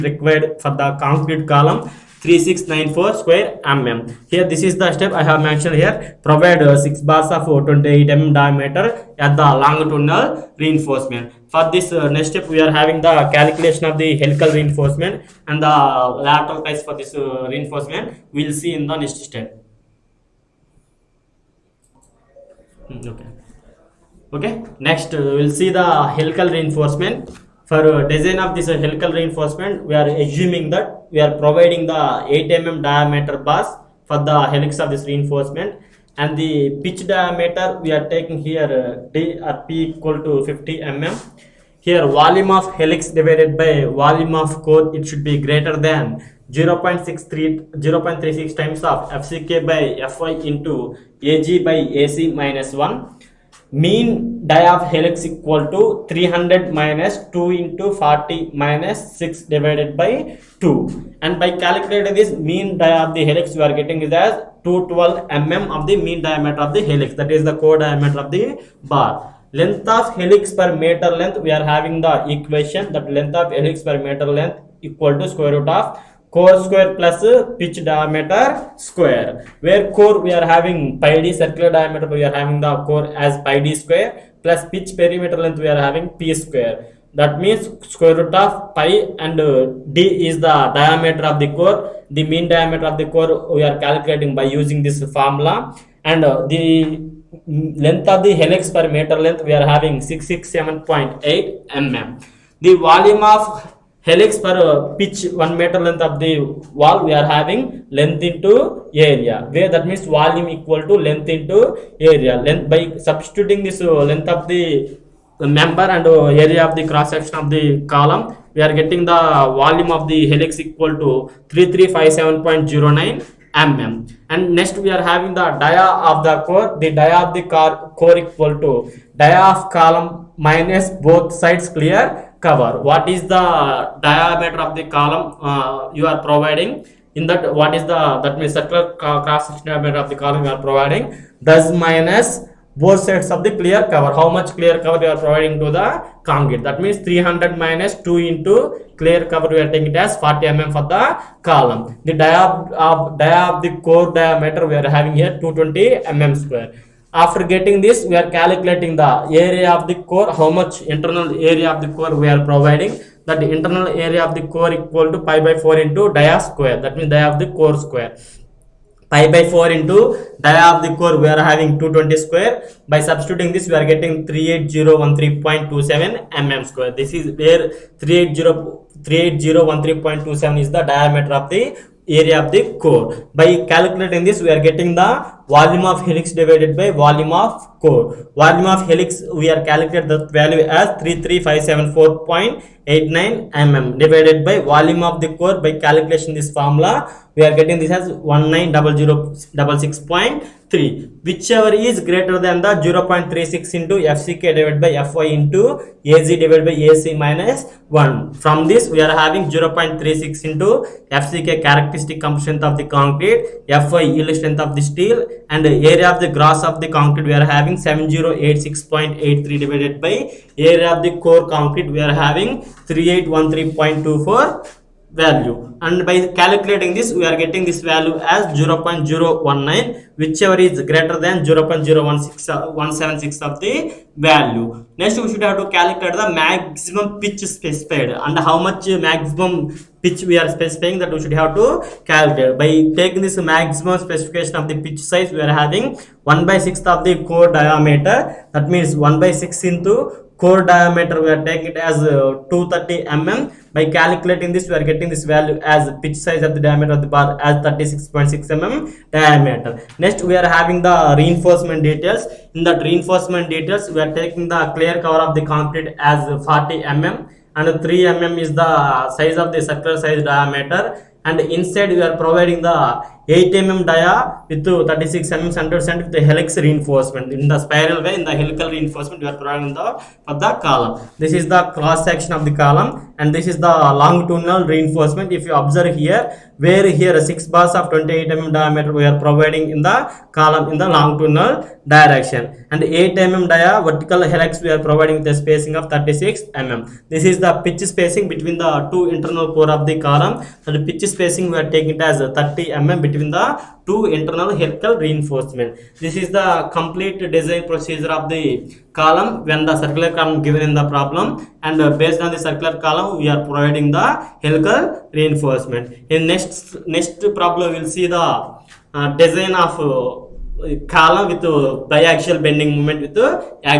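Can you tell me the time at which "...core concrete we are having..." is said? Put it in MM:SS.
03:41.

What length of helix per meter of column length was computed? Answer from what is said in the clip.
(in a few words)
667.8 mm.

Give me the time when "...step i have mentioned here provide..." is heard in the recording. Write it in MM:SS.
00:04.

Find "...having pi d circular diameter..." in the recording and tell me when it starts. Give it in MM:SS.
01:20.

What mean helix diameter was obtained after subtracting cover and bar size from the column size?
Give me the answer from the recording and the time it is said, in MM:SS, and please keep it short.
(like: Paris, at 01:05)
212 mm, at 01:04.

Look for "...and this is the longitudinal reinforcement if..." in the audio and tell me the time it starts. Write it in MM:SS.
04:43.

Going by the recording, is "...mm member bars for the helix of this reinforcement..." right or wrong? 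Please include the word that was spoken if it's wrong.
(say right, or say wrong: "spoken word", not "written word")
wrong: "diameter", not "member".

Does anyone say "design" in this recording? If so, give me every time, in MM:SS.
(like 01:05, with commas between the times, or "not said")
00:28, 05:07, 05:19.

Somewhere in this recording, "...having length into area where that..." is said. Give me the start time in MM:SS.
01:47.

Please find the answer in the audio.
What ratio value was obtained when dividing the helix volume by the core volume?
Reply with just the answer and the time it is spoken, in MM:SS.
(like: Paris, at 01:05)
0.019, at 03:48.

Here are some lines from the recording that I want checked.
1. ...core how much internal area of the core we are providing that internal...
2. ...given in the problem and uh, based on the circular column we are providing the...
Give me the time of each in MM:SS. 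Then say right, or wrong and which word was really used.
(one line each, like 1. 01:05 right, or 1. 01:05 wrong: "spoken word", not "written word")
1. 02:40 right
2. 05:10 right.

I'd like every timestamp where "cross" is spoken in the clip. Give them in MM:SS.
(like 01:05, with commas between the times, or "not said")
01:56, 02:19, 04:41.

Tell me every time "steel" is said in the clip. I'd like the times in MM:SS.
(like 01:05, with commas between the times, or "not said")
03:34.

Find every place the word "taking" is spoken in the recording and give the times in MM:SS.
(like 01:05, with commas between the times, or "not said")
00:38, 02:29, 04:02, 04:11, 04:24, 05:01.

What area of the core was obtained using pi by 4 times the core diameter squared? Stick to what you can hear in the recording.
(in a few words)
38013.27 mm².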